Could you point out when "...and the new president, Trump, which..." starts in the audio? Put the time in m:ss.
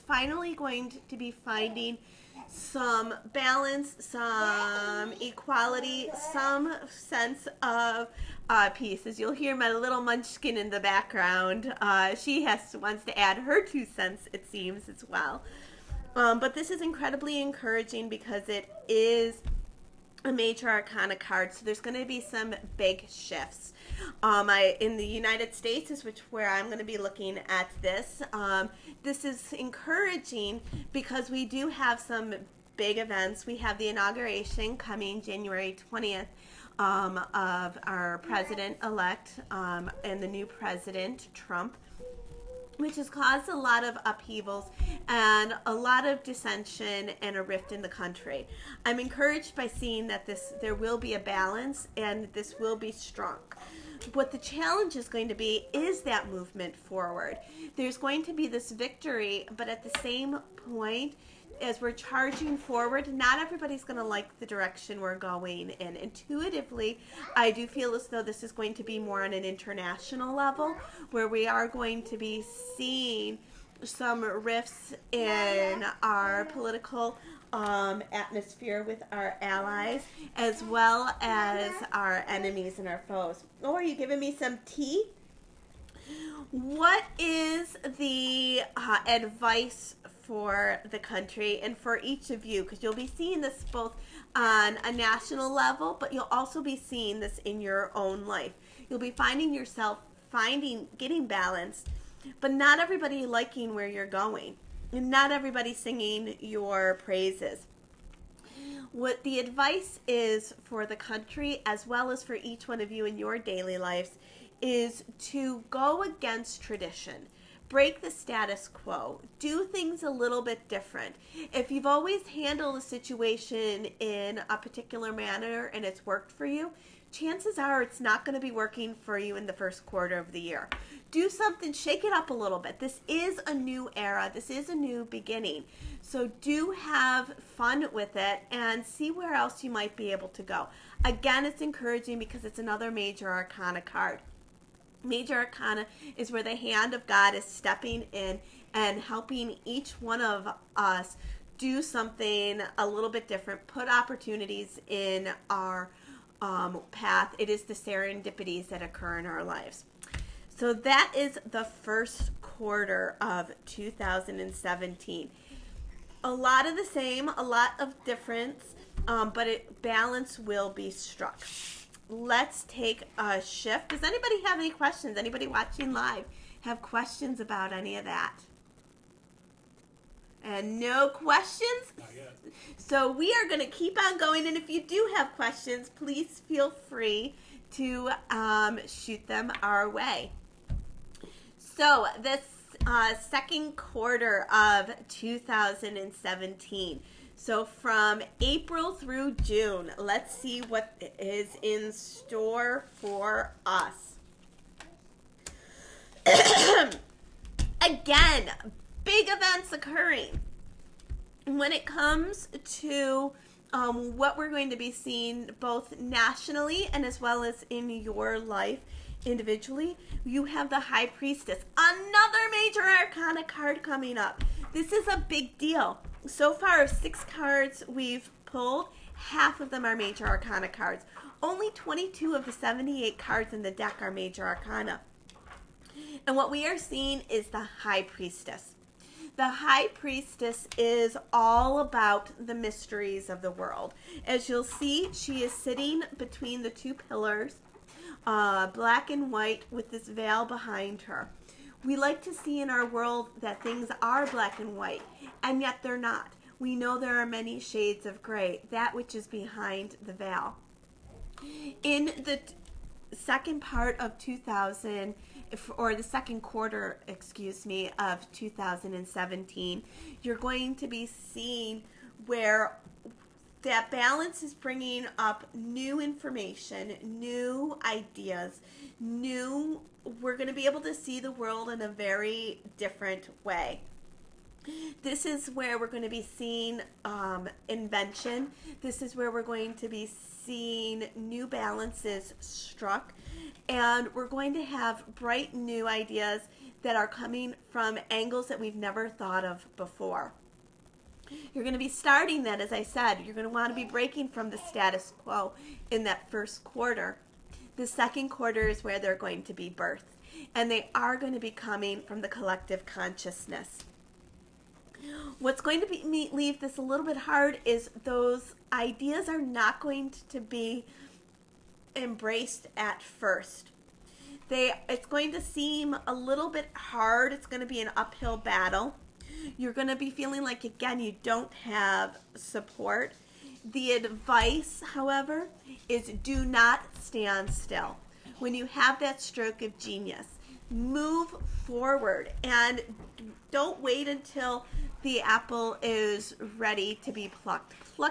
0:40.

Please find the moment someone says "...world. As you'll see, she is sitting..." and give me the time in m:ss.
4:03.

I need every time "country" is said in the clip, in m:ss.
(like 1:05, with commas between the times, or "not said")
0:47, 1:30, 1:50.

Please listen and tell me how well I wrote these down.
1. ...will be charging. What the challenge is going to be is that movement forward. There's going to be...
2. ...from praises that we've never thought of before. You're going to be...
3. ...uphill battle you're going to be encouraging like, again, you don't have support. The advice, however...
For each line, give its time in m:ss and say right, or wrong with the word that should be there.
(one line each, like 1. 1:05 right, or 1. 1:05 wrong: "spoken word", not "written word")
1. 0:52 wrong: "strong", not "charging"
2. 4:57 wrong: "angles", not "praises"
3. 5:27 wrong: "feeling", not "encouraging".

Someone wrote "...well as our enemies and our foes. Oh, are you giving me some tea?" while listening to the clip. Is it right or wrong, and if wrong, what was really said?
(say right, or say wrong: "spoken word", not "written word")
right.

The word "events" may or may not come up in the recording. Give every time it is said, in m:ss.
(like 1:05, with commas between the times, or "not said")
0:32, 3:29.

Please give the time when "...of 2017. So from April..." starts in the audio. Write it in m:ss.
3:14.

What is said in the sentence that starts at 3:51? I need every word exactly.
Only 22 of the 78 cards in the deck are Major Arcana.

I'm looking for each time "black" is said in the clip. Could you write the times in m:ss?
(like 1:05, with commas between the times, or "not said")
4:08, 4:14.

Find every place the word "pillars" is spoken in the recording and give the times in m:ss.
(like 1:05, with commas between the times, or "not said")
4:06.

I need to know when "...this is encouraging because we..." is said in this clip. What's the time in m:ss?
0:29.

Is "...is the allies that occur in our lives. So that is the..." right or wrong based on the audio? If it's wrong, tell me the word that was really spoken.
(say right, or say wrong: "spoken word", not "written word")
wrong: "serendipities", not "allies".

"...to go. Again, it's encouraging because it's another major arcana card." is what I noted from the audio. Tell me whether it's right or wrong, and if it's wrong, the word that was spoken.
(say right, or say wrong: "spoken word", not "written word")
right.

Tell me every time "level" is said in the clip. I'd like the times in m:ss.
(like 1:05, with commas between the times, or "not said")
1:10, 1:35.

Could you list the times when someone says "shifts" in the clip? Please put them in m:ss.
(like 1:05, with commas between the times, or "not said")
0:23, 2:53.